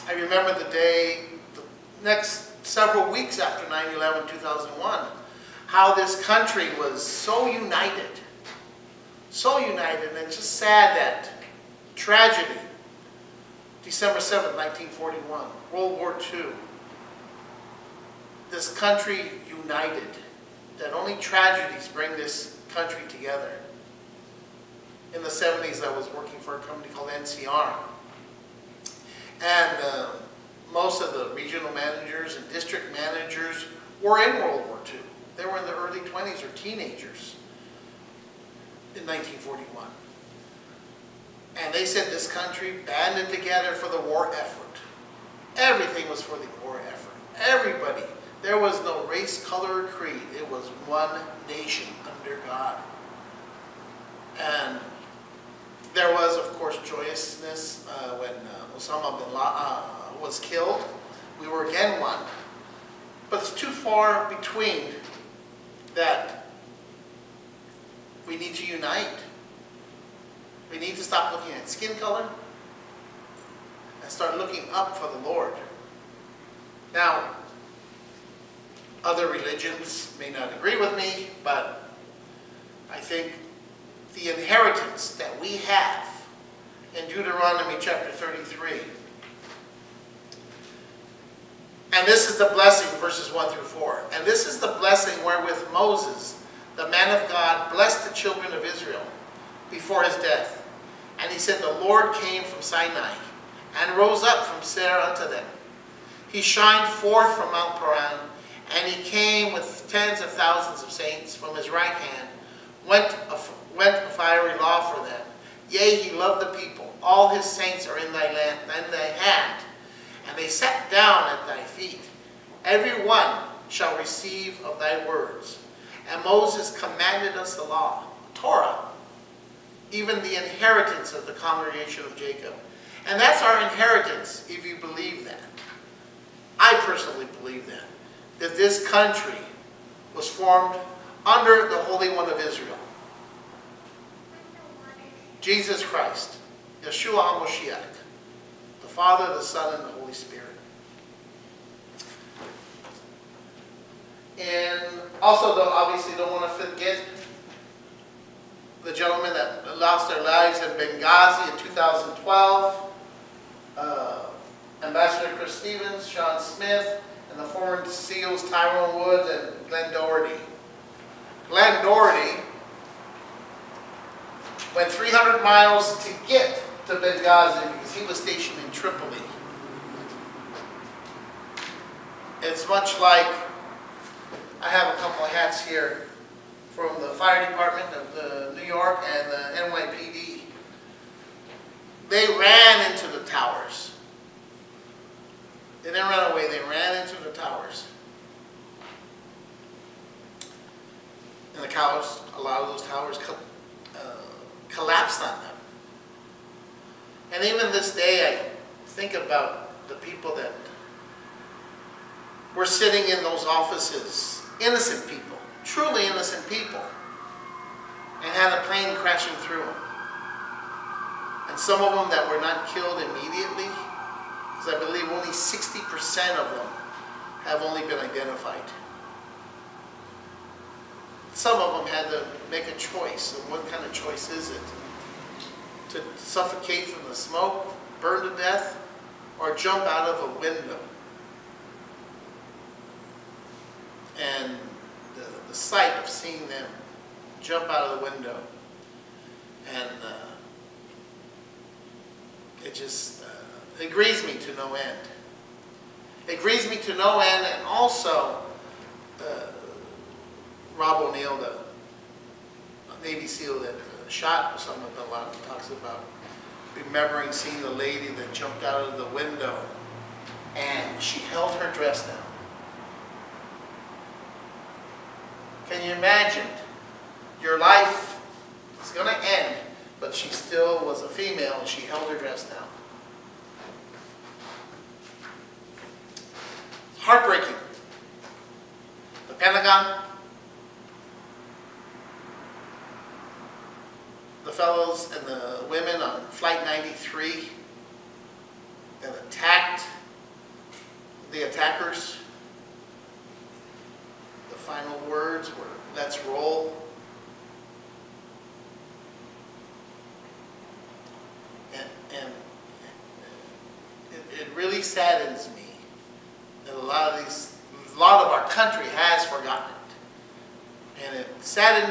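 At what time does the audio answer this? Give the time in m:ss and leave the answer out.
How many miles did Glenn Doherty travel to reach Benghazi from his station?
2:54.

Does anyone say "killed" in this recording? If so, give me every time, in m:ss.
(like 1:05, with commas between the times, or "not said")
1:00, 3:42.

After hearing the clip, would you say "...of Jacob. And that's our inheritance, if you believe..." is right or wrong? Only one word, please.
right.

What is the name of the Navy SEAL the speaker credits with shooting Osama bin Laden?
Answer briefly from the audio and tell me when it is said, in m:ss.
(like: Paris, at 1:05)
Rob O'Neill, at 4:20.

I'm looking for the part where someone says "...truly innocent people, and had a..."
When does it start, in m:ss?
3:35.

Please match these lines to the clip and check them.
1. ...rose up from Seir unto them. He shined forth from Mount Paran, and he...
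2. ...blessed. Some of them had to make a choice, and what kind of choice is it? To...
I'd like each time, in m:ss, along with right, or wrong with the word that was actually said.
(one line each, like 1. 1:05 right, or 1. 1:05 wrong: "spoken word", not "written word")
1. 1:43 right
2. 3:47 wrong: "identified", not "blessed".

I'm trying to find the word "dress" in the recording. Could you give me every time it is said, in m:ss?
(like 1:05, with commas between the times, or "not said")
4:31, 4:42.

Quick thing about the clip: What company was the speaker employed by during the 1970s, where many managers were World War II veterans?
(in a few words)
NCR.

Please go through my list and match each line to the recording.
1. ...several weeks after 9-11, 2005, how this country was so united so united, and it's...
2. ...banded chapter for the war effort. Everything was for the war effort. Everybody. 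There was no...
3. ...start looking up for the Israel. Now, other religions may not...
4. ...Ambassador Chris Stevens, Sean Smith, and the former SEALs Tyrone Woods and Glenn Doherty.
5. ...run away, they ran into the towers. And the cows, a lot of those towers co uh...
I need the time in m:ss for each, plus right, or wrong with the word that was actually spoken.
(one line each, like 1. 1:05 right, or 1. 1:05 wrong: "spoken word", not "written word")
1. 0:02 wrong: "2001", not "2005"
2. 0:42 wrong: "together", not "chapter"
3. 1:14 wrong: "Lord", not "Israel"
4. 2:44 right
5. 3:16 right.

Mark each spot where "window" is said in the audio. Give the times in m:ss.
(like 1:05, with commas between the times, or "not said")
4:00, 4:08, 4:29.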